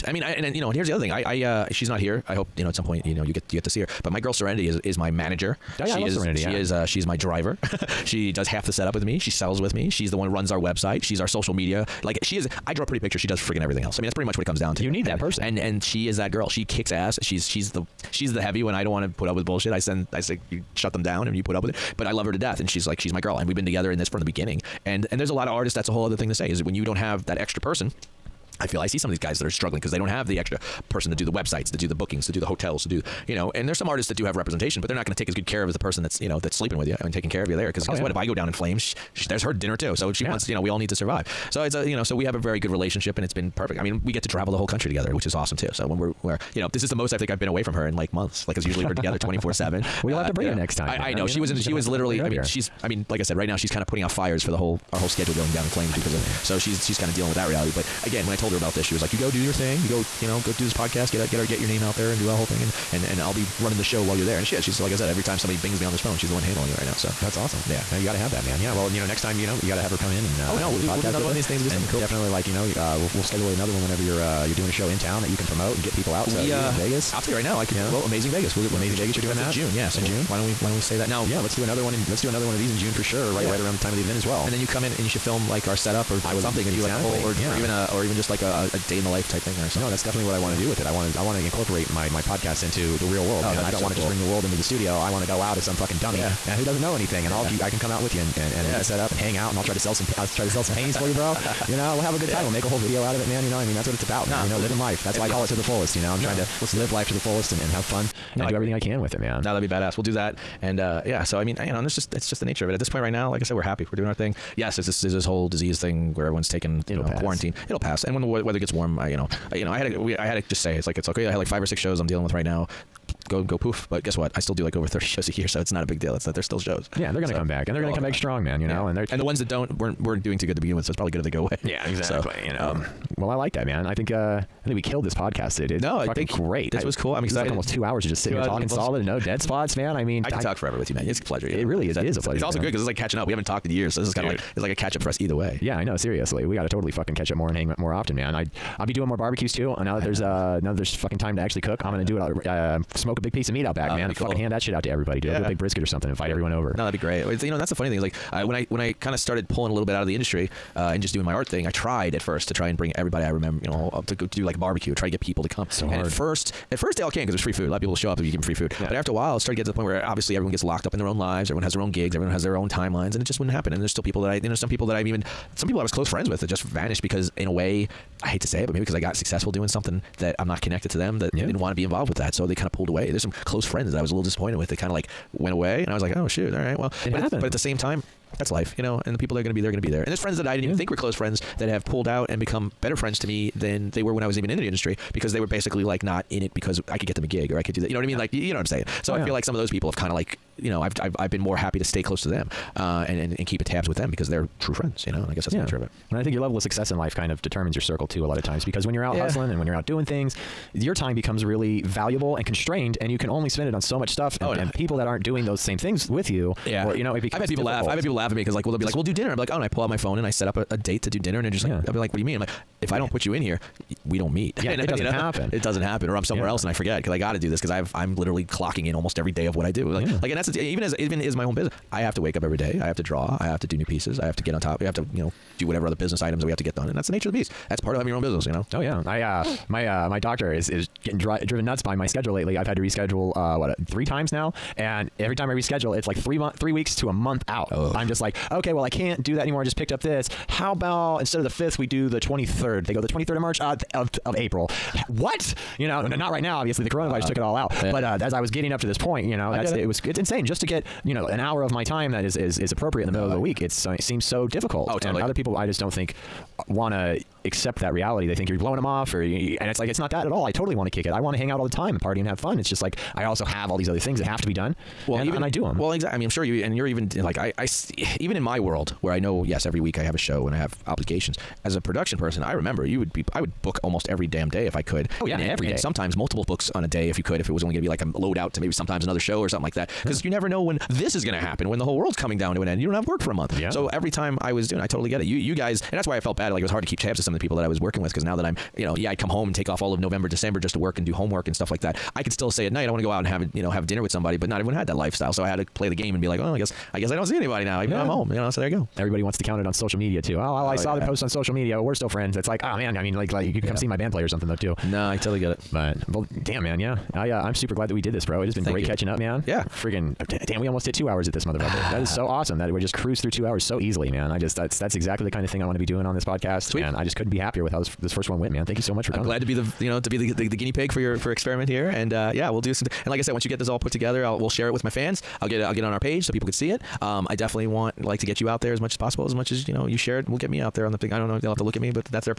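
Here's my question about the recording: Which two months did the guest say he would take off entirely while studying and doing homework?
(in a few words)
November, December.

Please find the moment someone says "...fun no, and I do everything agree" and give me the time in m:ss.
1:47.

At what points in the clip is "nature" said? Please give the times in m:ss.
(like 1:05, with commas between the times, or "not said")
1:52, 3:25, 3:57.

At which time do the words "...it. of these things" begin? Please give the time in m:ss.
1:11.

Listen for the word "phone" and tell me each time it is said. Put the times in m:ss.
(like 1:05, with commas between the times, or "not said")
1:05, 3:39.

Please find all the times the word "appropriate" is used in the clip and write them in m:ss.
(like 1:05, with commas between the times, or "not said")
4:22.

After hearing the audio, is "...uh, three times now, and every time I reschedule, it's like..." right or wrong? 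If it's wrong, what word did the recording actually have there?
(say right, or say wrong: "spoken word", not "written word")
right.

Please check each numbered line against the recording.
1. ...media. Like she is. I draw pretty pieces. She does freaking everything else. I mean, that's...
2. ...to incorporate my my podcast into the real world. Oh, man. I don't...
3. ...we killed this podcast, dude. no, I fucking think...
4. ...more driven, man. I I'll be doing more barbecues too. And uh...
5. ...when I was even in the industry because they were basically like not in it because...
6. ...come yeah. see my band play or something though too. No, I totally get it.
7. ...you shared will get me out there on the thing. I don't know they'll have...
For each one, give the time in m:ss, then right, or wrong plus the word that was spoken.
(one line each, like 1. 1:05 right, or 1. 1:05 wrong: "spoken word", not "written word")
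1. 0:11 wrong: "pictures", not "pieces"
2. 1:31 right
3. 2:14 right
4. 2:27 wrong: "often", not "driven"
5. 3:14 right
6. 5:13 right
7. 5:39 right.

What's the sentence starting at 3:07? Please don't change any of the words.
At, but at the same time, that's life, you know.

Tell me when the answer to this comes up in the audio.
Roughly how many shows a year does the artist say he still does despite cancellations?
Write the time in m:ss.
2:04.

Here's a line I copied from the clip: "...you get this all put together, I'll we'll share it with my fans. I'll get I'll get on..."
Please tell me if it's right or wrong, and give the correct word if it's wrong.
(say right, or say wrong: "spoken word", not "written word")
right.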